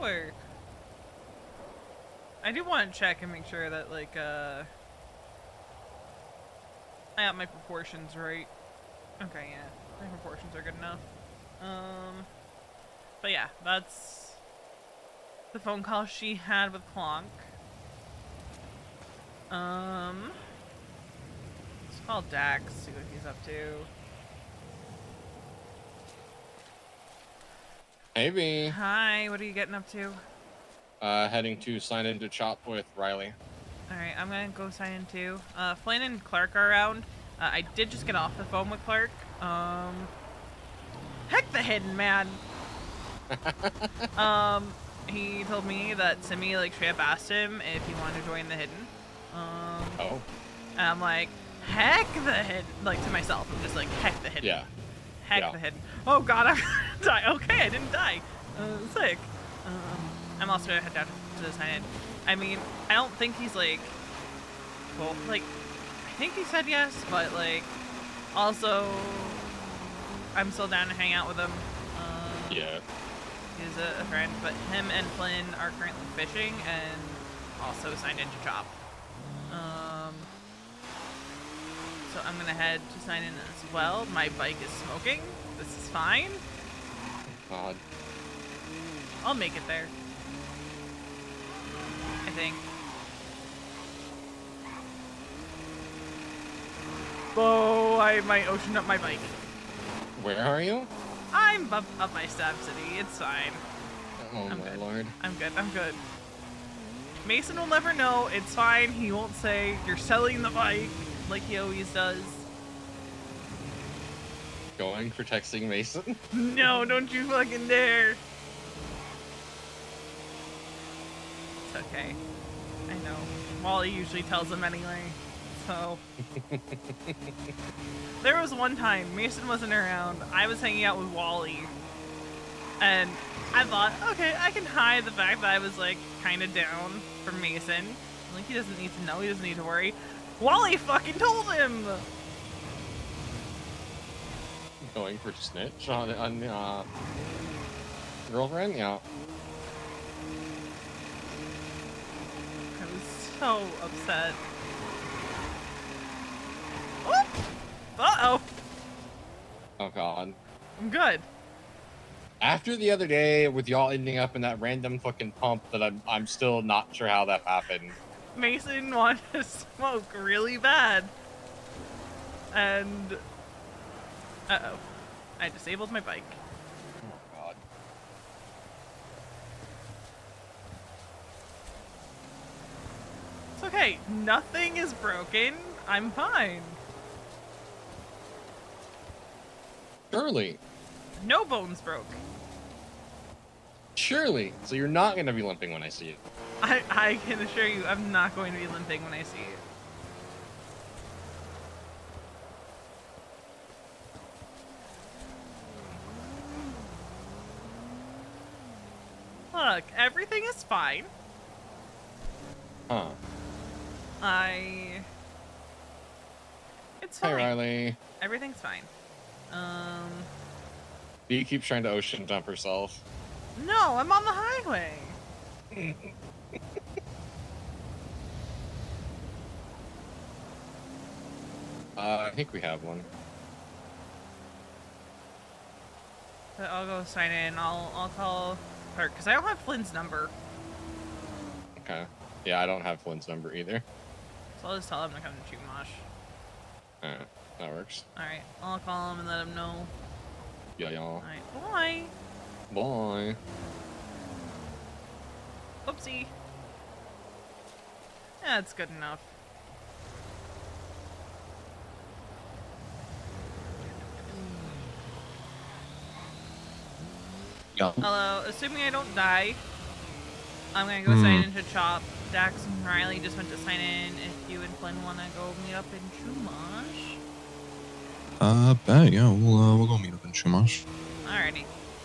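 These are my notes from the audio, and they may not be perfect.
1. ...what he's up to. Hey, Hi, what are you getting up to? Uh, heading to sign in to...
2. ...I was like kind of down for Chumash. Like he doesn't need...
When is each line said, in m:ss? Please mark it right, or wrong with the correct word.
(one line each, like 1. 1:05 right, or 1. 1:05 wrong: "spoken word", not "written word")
1. 0:22 right
2. 2:15 wrong: "Mason", not "Chumash".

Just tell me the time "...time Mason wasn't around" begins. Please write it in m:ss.
2:08.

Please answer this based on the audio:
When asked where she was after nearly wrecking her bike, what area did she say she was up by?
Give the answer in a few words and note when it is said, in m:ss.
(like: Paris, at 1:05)
Stab City, at 1:42.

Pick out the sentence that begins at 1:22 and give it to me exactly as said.
I'm gonna head to sign in as well.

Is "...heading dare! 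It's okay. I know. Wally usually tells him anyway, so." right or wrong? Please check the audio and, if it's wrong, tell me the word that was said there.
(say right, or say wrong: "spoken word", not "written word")
wrong: "fucking", not "heading".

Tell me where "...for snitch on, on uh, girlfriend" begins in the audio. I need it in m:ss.
2:25.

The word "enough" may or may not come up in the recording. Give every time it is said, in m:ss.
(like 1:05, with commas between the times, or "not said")
0:10, 4:18.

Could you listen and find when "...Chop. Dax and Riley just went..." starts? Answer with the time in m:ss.
4:31.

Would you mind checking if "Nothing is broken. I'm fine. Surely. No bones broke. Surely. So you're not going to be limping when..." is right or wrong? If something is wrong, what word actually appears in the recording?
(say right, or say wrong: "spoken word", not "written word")
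right.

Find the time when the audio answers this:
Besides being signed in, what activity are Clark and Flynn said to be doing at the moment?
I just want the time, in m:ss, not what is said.
1:16.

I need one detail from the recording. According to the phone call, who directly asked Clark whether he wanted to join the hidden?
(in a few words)
Simi.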